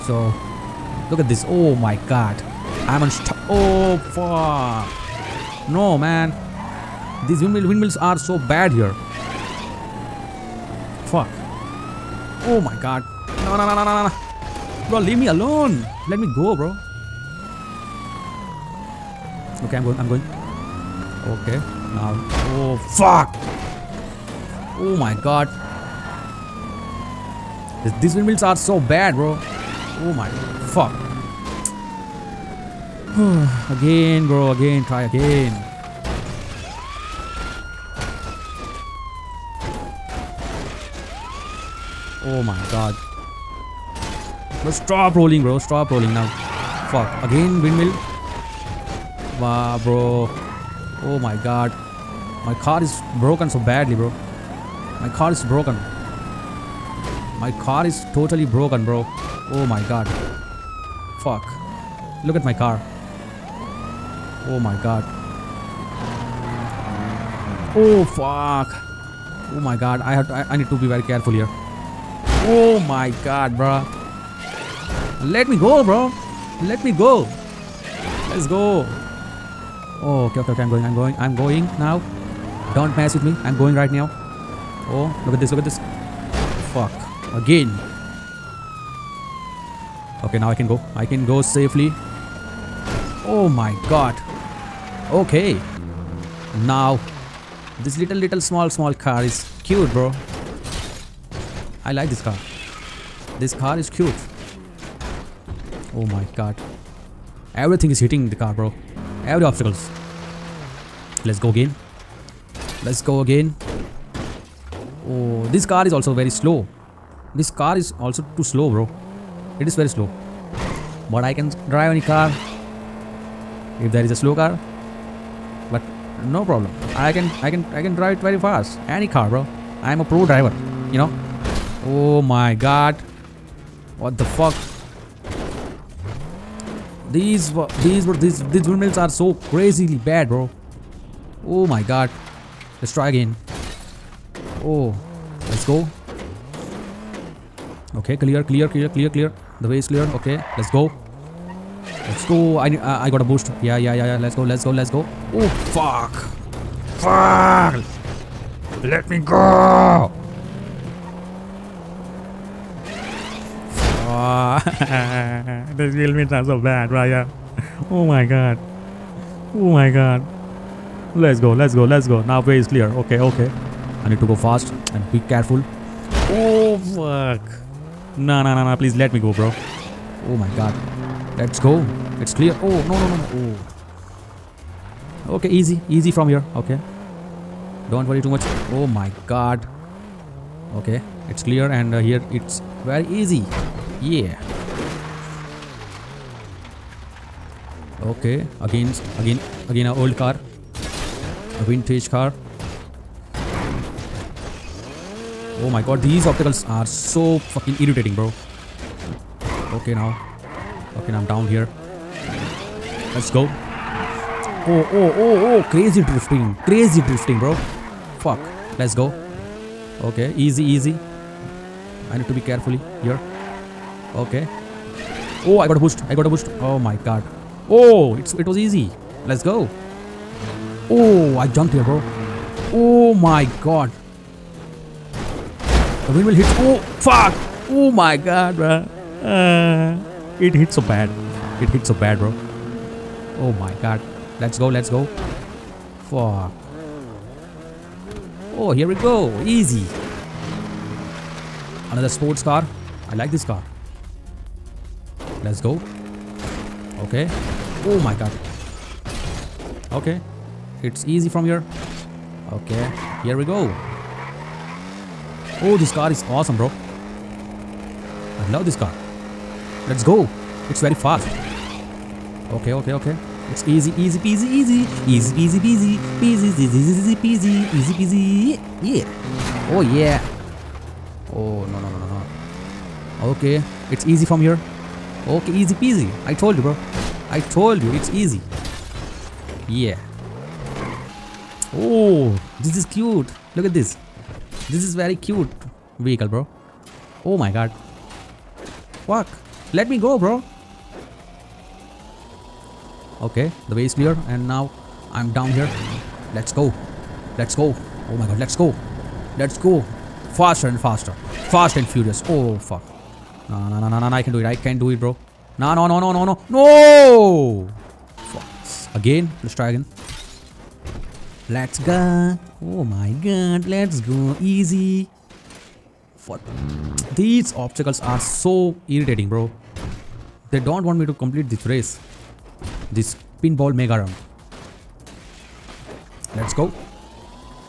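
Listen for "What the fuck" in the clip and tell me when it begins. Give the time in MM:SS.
02:13.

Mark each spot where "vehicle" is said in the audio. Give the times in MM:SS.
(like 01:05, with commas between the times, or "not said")
04:55.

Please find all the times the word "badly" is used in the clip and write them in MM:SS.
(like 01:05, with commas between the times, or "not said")
00:53.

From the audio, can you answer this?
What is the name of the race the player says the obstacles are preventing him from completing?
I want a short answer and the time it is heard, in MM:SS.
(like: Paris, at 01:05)
pinball mega round, at 05:33.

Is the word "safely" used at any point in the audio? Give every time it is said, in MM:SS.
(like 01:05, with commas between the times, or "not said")
01:31.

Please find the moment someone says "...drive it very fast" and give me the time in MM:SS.
02:07.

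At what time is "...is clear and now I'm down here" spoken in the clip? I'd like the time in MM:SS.
05:03.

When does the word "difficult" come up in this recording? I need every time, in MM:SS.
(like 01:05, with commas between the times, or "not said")
not said.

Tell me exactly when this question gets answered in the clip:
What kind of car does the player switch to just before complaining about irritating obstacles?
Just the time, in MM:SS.
03:21.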